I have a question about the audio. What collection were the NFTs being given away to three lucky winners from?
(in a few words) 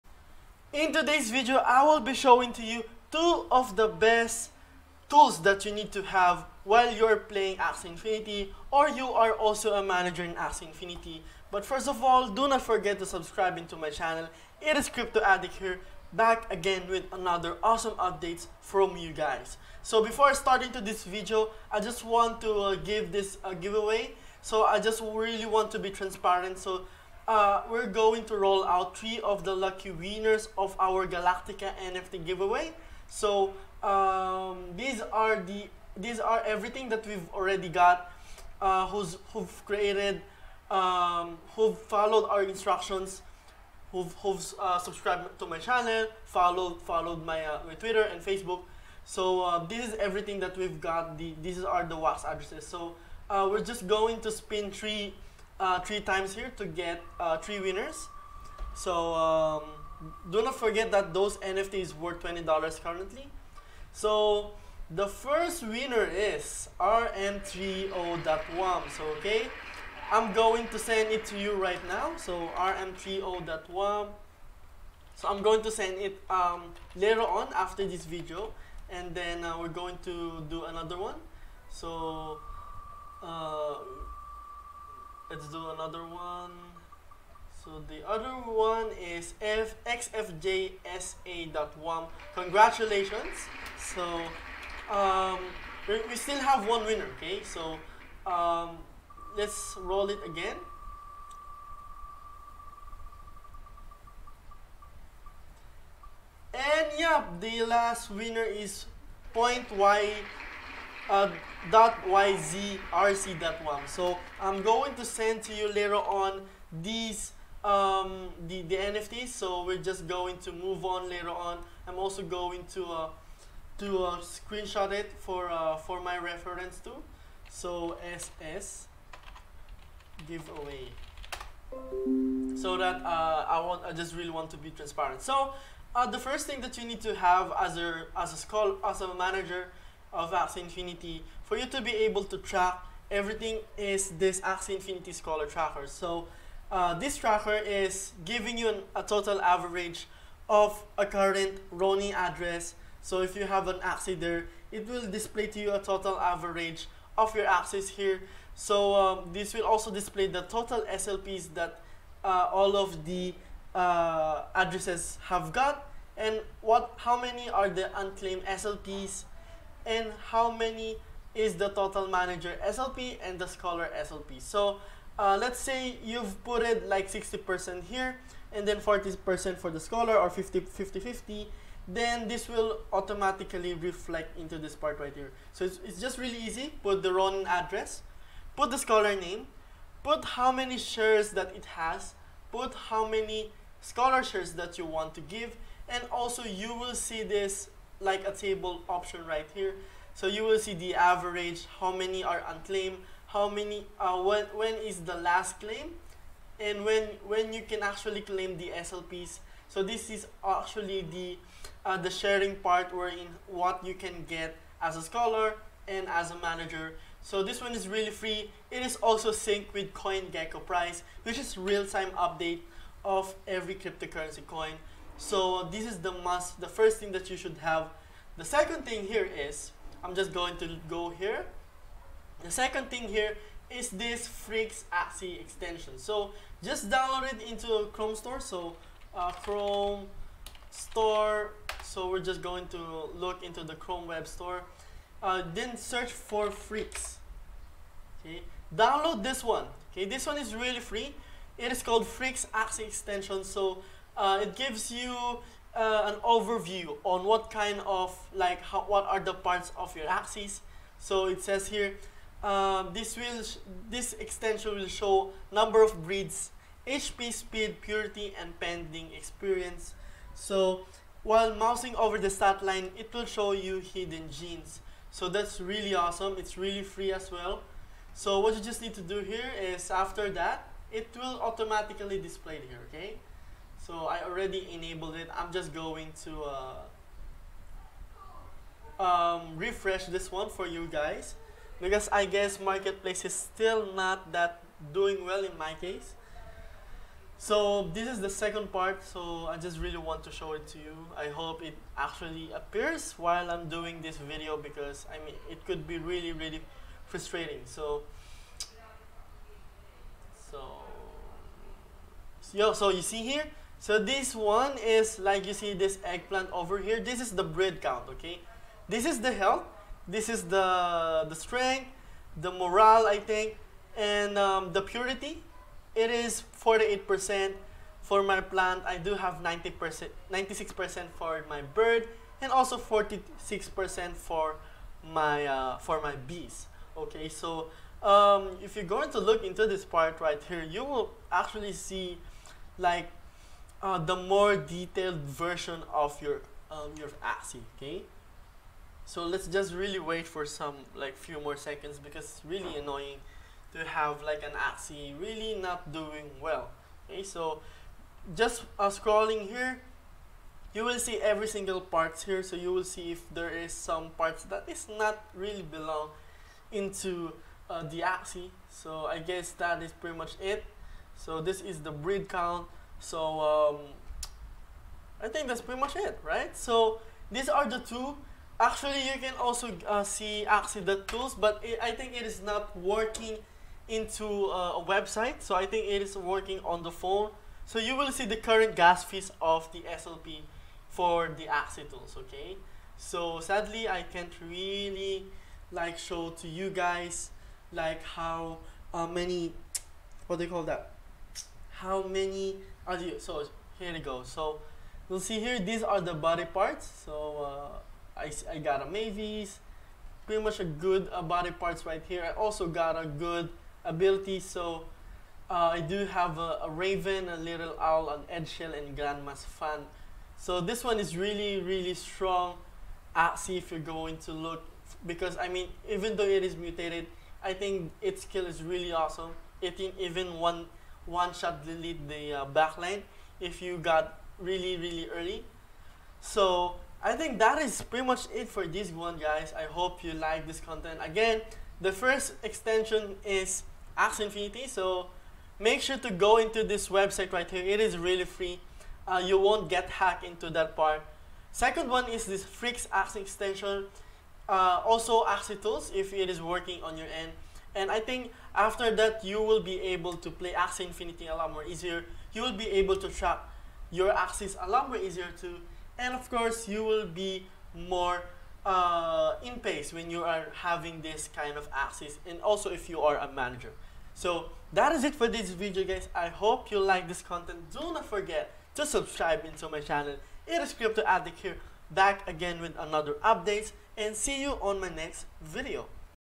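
Galactica.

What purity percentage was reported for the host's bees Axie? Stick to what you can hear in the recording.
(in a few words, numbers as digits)
46%.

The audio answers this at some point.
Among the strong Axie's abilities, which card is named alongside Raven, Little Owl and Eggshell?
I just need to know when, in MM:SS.
06:58.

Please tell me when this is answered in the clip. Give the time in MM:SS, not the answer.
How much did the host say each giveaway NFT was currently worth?
01:02.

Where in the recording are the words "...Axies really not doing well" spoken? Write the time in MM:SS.
05:54.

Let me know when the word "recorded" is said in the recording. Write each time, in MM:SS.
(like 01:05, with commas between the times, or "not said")
not said.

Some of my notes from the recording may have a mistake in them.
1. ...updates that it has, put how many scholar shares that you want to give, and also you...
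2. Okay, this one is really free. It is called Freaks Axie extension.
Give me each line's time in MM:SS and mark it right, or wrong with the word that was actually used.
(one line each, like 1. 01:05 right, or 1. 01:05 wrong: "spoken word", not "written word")
1. 03:10 wrong: "shares", not "updates"
2. 04:09 right.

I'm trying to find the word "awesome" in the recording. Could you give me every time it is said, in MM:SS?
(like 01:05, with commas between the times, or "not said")
00:17, 04:35, 07:08.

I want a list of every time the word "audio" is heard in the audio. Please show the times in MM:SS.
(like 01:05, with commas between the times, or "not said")
not said.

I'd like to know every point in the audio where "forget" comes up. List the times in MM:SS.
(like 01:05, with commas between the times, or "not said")
00:12, 01:00, 07:58.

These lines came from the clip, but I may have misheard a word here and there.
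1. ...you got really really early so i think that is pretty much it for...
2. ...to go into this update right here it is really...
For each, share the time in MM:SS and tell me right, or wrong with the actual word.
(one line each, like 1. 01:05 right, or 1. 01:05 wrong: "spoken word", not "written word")
1. 07:13 right
2. 07:25 wrong: "website", not "update".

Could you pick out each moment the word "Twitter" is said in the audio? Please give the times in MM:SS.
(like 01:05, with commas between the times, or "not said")
00:47.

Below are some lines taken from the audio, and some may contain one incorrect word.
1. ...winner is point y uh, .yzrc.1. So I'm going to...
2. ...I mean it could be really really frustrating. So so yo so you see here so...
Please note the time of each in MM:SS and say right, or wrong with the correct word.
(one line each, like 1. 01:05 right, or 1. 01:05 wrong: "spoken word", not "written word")
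1. 01:48 right
2. 05:05 right.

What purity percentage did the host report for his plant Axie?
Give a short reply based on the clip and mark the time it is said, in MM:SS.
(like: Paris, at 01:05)
48%, at 05:26.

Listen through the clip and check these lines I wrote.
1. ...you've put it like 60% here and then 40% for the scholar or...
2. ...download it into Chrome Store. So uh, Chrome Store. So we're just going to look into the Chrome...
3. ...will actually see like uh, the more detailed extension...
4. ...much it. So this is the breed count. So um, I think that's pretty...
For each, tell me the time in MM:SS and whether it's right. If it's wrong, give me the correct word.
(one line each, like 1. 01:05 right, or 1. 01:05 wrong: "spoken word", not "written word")
1. 02:56 right
2. 03:56 right
3. 05:40 wrong: "version", not "extension"
4. 06:10 right.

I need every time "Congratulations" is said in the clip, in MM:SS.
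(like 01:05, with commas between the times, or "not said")
01:32.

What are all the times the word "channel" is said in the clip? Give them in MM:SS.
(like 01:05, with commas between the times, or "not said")
00:13, 00:45, 07:59.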